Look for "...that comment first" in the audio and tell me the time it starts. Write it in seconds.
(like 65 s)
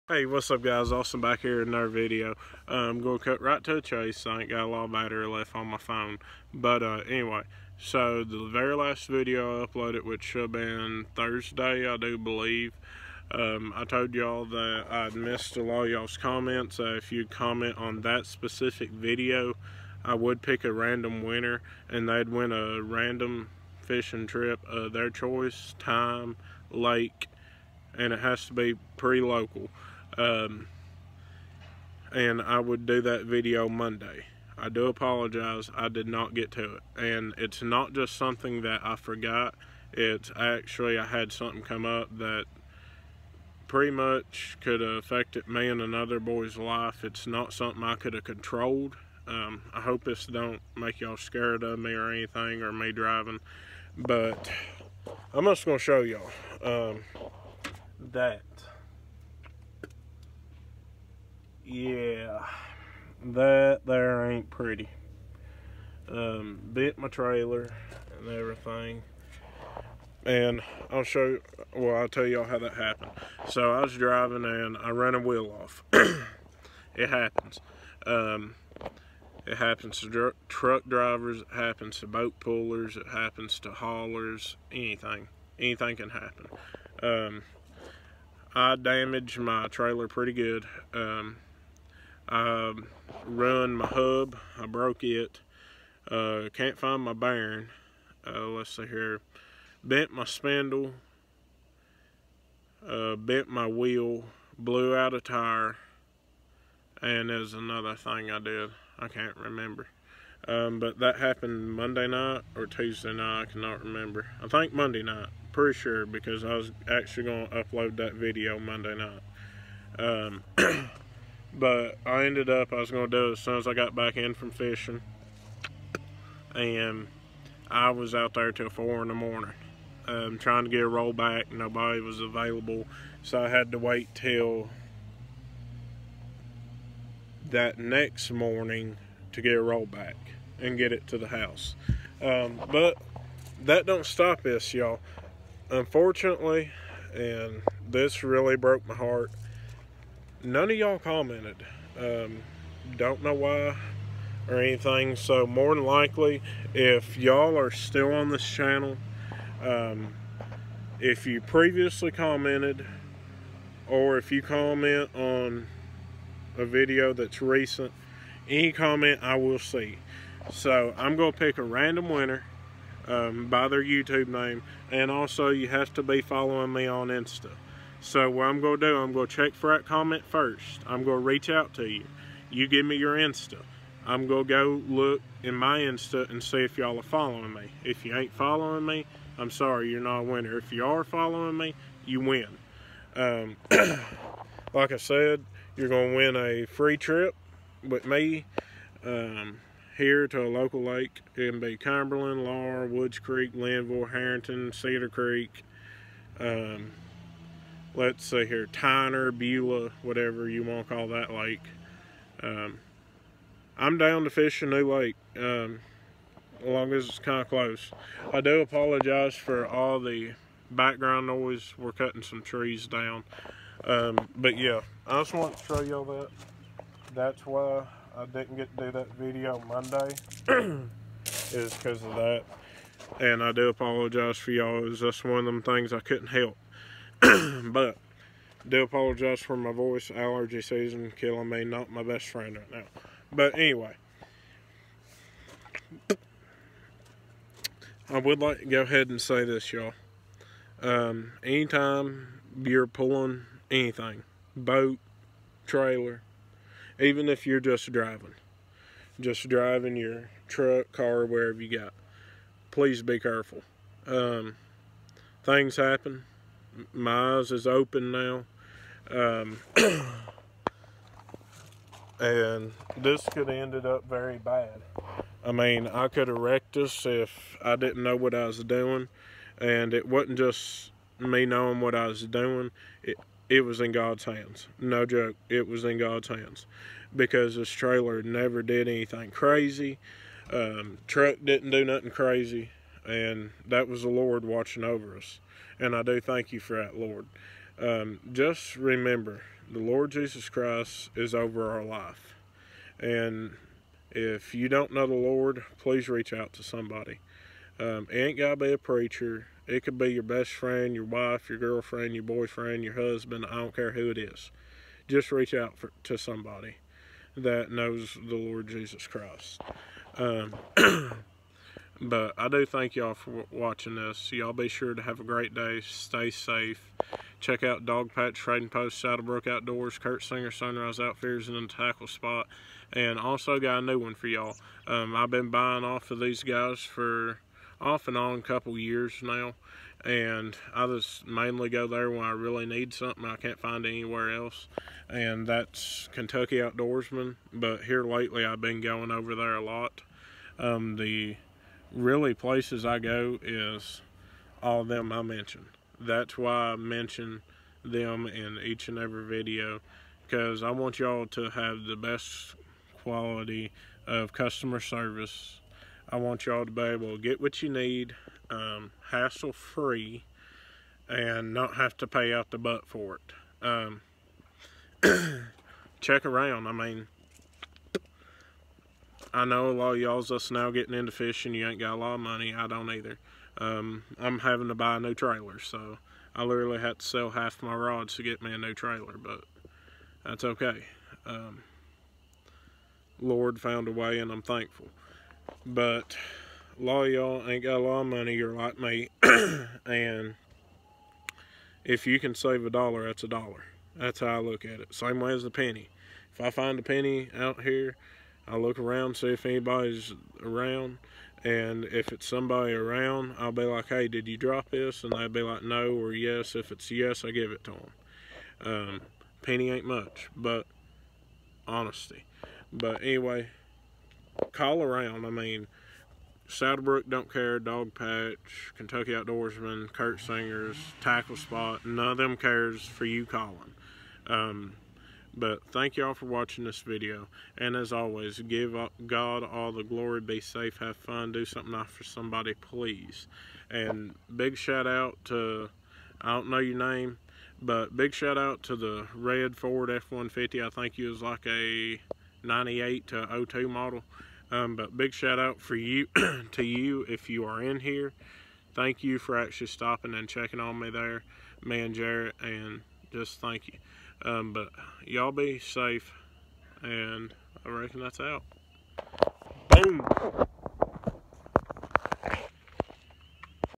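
179 s.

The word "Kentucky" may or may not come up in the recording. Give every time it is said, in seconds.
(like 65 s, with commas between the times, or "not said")
346 s, 428 s.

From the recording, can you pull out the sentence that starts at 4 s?
I ain't got a lot of battery left on my phone.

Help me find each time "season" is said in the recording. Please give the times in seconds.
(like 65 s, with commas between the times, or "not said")
240 s.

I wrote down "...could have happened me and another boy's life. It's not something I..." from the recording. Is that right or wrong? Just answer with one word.
wrong.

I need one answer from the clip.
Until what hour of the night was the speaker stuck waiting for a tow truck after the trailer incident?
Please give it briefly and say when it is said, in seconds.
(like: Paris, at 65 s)
4 in the morning, at 128 s.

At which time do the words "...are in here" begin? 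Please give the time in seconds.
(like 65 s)
457 s.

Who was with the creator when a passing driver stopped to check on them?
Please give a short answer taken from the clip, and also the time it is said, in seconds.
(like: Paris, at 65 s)
Jarrett, at 461 s.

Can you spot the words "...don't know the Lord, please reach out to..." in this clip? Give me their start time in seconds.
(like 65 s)
304 s.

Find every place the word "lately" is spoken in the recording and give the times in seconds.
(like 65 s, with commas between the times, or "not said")
348 s.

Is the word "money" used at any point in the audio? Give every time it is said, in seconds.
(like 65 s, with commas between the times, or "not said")
382 s, 398 s.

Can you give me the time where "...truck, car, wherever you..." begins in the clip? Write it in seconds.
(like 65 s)
260 s.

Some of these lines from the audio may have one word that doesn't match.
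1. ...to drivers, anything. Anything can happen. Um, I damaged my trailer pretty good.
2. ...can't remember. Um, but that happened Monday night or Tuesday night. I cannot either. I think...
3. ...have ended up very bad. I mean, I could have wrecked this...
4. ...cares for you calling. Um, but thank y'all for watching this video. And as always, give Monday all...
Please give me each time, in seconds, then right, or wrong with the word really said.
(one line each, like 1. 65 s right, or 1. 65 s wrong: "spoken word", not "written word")
1. 83 s wrong: "haulers", not "drivers"
2. 109 s wrong: "remember", not "either"
3. 273 s right
4. 432 s wrong: "God", not "Monday".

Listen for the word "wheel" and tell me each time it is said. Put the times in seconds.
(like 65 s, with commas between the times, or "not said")
75 s, 103 s.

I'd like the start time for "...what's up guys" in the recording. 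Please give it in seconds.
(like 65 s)
0 s.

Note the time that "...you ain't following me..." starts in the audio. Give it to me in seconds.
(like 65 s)
188 s.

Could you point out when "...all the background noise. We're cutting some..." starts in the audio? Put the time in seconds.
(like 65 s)
219 s.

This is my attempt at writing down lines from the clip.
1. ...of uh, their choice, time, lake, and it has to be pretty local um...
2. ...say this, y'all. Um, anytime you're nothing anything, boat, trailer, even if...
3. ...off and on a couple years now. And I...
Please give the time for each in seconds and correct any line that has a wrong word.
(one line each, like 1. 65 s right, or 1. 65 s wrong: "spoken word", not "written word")
1. 24 s right
2. 249 s wrong: "pulling", not "nothing"
3. 337 s right.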